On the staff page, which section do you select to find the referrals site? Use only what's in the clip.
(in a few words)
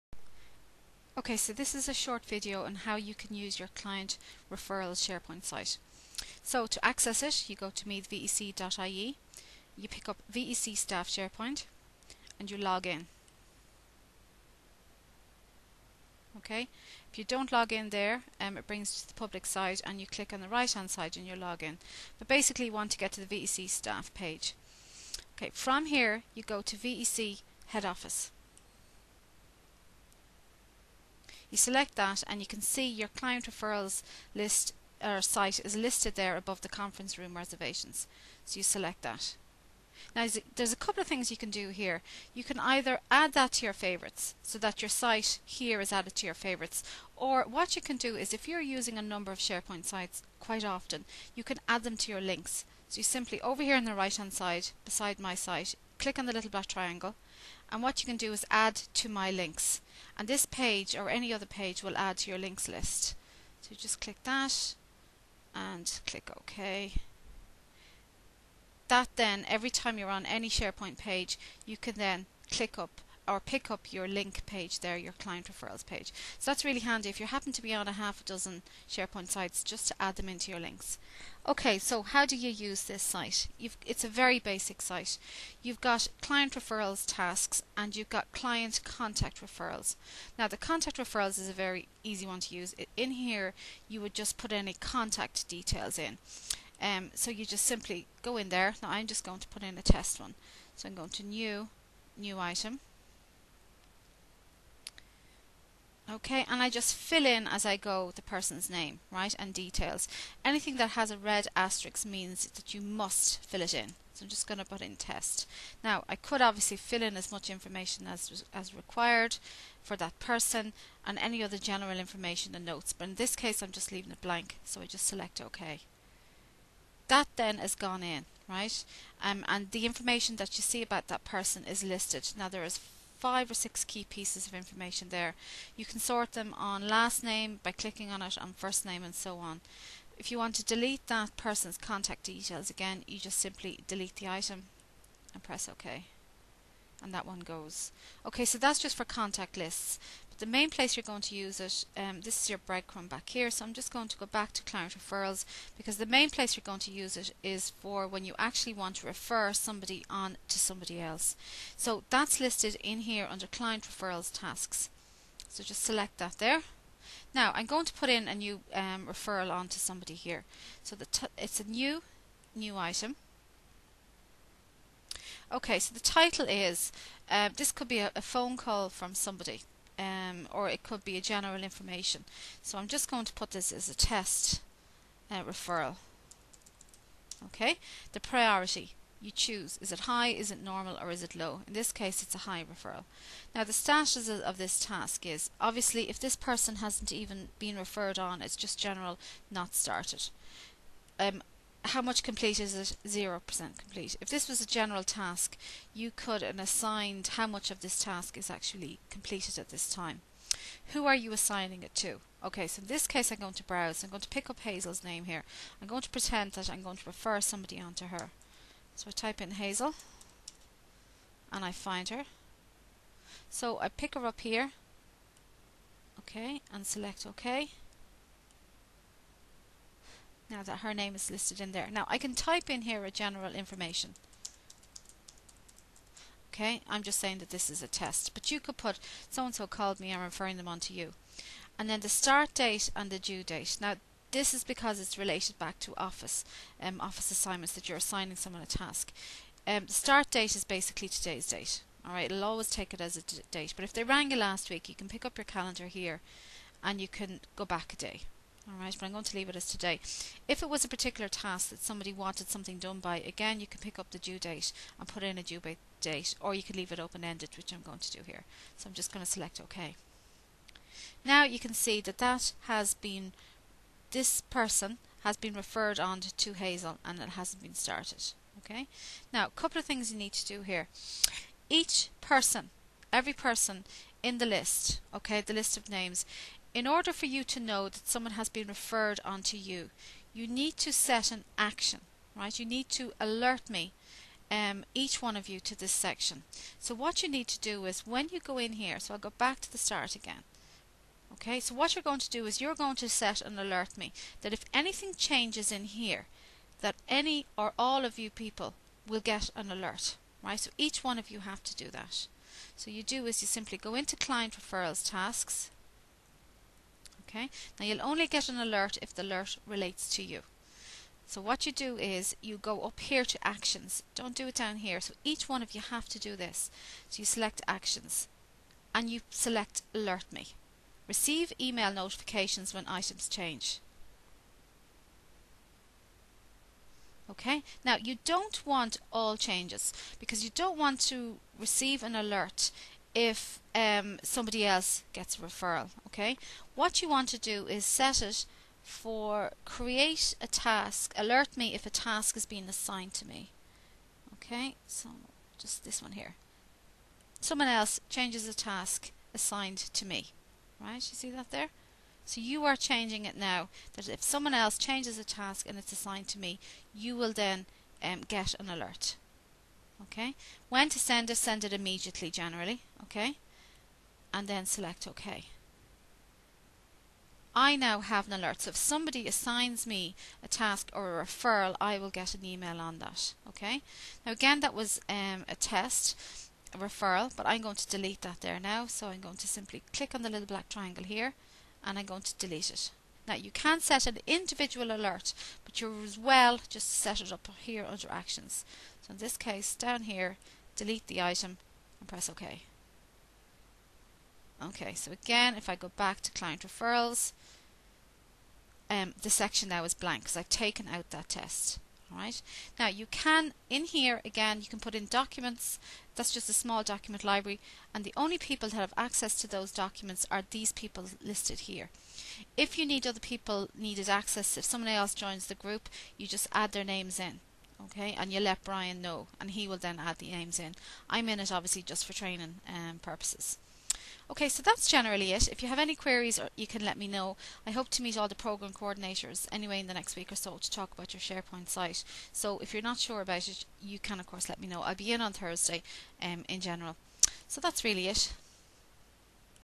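VEC Head Office.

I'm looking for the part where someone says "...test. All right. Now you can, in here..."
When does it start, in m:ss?
6:51.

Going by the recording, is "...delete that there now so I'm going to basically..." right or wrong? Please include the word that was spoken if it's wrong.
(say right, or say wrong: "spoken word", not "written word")
wrong: "simply", not "basically".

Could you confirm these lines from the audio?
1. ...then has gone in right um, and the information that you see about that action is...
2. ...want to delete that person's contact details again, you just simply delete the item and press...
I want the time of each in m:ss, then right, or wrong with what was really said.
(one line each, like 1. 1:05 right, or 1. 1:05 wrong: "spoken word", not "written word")
1. 2:07 wrong: "person", not "action"
2. 2:20 right.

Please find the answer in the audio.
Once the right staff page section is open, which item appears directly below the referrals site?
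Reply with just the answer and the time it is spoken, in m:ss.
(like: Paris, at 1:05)
conference room reservations, at 0:36.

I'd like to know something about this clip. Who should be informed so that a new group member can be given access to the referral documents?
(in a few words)
Brian.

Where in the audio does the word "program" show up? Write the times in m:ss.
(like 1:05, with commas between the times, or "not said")
7:18.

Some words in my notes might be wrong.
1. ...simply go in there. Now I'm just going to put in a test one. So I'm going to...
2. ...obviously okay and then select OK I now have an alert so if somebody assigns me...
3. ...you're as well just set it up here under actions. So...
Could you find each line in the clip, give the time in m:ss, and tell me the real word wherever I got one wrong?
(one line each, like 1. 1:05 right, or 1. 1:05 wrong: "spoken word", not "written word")
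1. 1:37 right
2. 6:12 wrong: "generally", not "obviously"
3. 6:35 right.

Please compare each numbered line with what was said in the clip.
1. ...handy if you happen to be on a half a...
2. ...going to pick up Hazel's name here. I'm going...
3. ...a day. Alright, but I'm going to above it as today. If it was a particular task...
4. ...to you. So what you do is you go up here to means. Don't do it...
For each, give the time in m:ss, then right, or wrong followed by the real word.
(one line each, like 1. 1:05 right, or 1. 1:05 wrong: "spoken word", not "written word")
1. 1:16 right
2. 3:34 right
3. 4:17 wrong: "leave", not "above"
4. 5:20 wrong: "actions", not "means".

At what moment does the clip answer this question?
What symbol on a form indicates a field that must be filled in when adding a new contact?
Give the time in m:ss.
1:51.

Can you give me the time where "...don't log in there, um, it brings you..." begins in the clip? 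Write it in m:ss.
0:17.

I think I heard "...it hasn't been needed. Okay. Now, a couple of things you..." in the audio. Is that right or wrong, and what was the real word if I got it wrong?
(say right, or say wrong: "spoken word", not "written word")
wrong: "started", not "needed".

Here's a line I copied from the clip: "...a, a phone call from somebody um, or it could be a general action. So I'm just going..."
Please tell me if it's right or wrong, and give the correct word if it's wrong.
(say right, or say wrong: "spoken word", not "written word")
wrong: "information", not "action".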